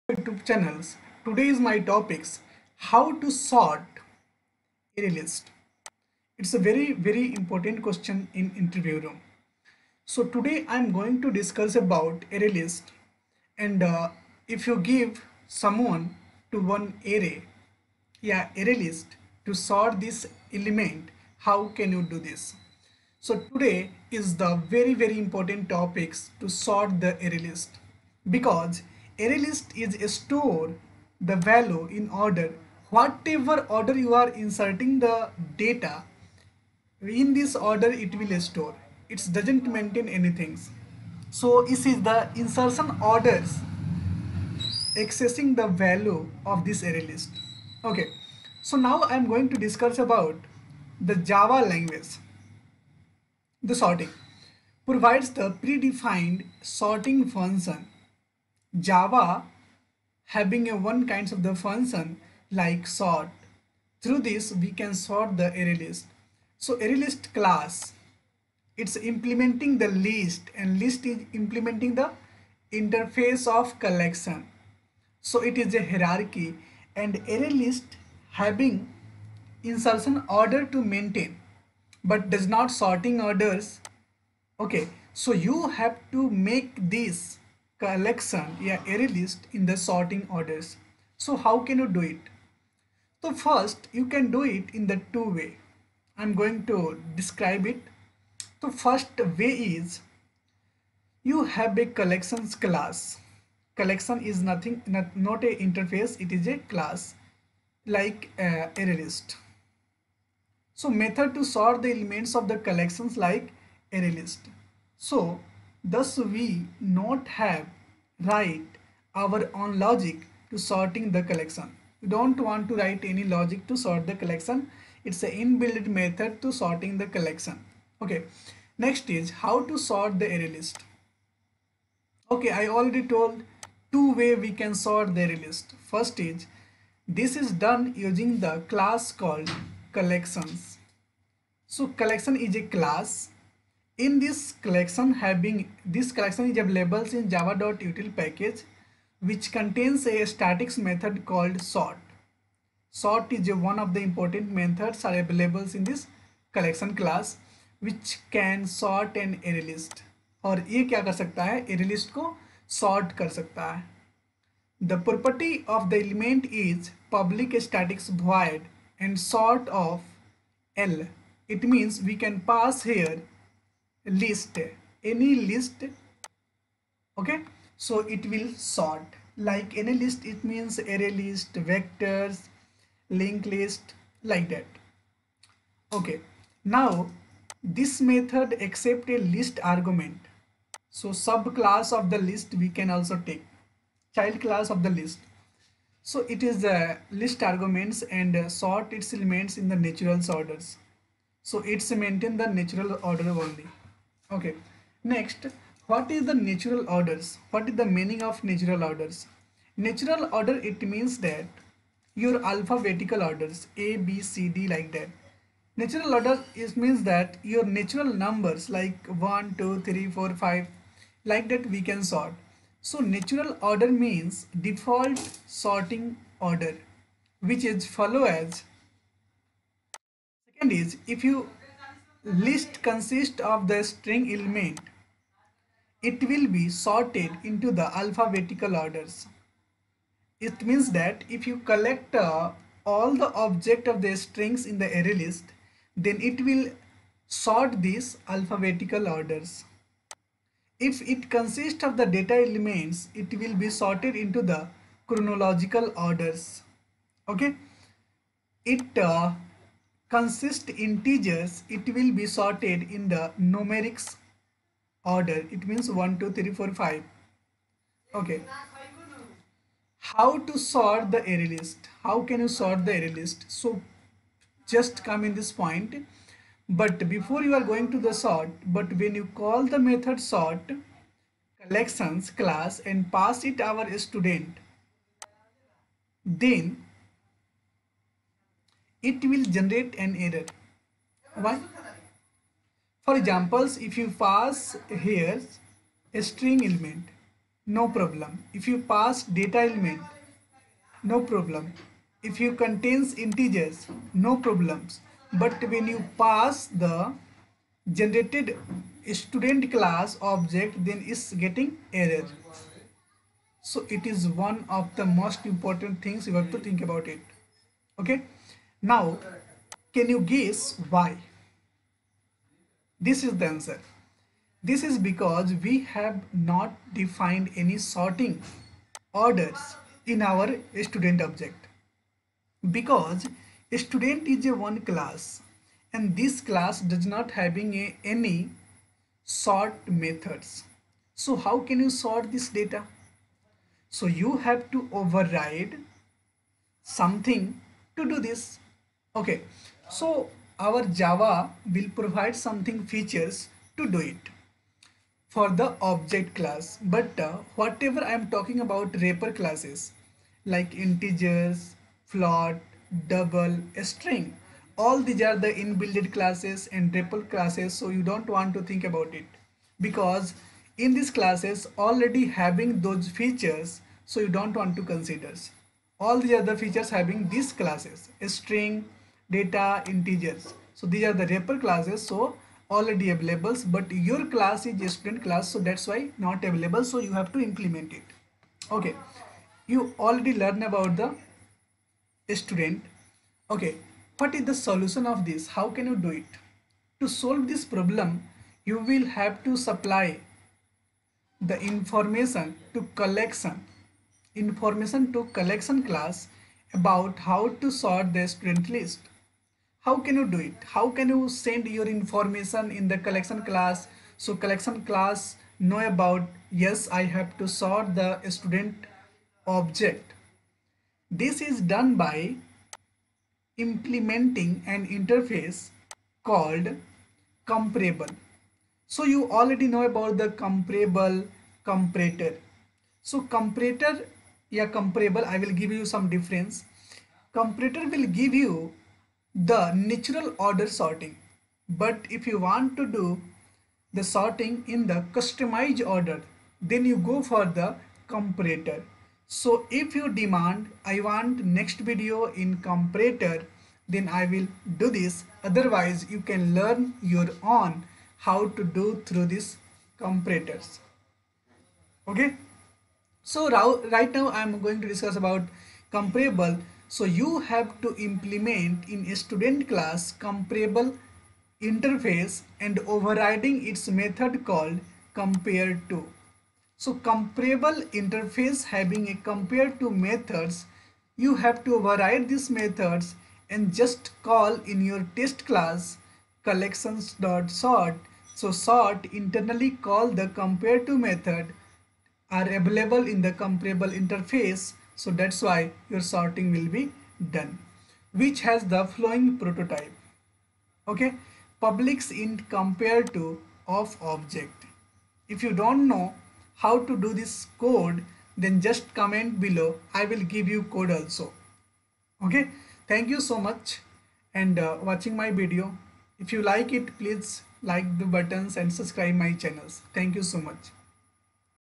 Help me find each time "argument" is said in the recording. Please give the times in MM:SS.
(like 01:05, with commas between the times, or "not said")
03:09, 03:17.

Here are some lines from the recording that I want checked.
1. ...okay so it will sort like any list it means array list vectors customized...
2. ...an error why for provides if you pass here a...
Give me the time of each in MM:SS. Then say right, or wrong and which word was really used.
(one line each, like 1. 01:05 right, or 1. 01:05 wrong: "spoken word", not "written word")
1. 02:57 wrong: "linked", not "customized"
2. 04:50 wrong: "examples", not "provides".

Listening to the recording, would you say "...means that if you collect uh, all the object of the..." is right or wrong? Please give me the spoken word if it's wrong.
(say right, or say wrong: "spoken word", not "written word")
right.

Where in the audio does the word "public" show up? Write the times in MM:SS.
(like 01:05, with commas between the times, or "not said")
02:47, 08:21.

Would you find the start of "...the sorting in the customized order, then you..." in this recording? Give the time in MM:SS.
07:23.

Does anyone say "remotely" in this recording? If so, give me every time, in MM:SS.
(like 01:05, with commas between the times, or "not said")
not said.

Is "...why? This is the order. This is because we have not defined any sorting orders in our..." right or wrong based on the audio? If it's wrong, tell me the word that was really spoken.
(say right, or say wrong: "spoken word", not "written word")
wrong: "answer", not "order".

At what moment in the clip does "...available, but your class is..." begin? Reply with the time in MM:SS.
06:23.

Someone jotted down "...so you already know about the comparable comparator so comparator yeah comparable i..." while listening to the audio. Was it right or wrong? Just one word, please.
right.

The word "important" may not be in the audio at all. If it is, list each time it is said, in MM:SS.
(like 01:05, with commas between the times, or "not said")
00:07, 00:25, 02:34, 05:15.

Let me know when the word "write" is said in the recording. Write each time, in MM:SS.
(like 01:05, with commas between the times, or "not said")
01:58, 02:02.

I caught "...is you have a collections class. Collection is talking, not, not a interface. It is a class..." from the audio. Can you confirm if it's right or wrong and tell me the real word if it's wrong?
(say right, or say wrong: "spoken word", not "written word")
wrong: "nothing", not "talking".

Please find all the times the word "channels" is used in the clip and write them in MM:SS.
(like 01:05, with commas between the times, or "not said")
00:00, 08:39.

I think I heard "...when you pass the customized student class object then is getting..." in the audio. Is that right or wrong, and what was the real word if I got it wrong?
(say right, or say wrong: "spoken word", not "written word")
wrong: "generated", not "customized".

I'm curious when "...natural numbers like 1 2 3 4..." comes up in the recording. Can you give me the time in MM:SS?
03:37.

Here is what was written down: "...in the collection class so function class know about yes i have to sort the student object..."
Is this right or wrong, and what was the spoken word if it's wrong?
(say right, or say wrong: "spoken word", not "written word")
wrong: "collection", not "function".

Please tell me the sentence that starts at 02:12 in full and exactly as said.
Okay, I already told two way we can sort the array list.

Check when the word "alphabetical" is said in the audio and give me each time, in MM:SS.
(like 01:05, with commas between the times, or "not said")
03:32, 03:57, 04:08.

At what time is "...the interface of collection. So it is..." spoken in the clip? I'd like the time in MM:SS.
01:11.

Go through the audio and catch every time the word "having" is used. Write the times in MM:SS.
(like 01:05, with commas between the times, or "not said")
01:00, 01:18, 02:25, 05:37, 06:12, 06:16, 07:58.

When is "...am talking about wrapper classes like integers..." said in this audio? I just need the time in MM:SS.
05:58.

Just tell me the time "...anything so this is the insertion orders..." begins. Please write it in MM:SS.
00:40.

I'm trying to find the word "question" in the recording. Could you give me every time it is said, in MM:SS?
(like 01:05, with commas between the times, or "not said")
00:07.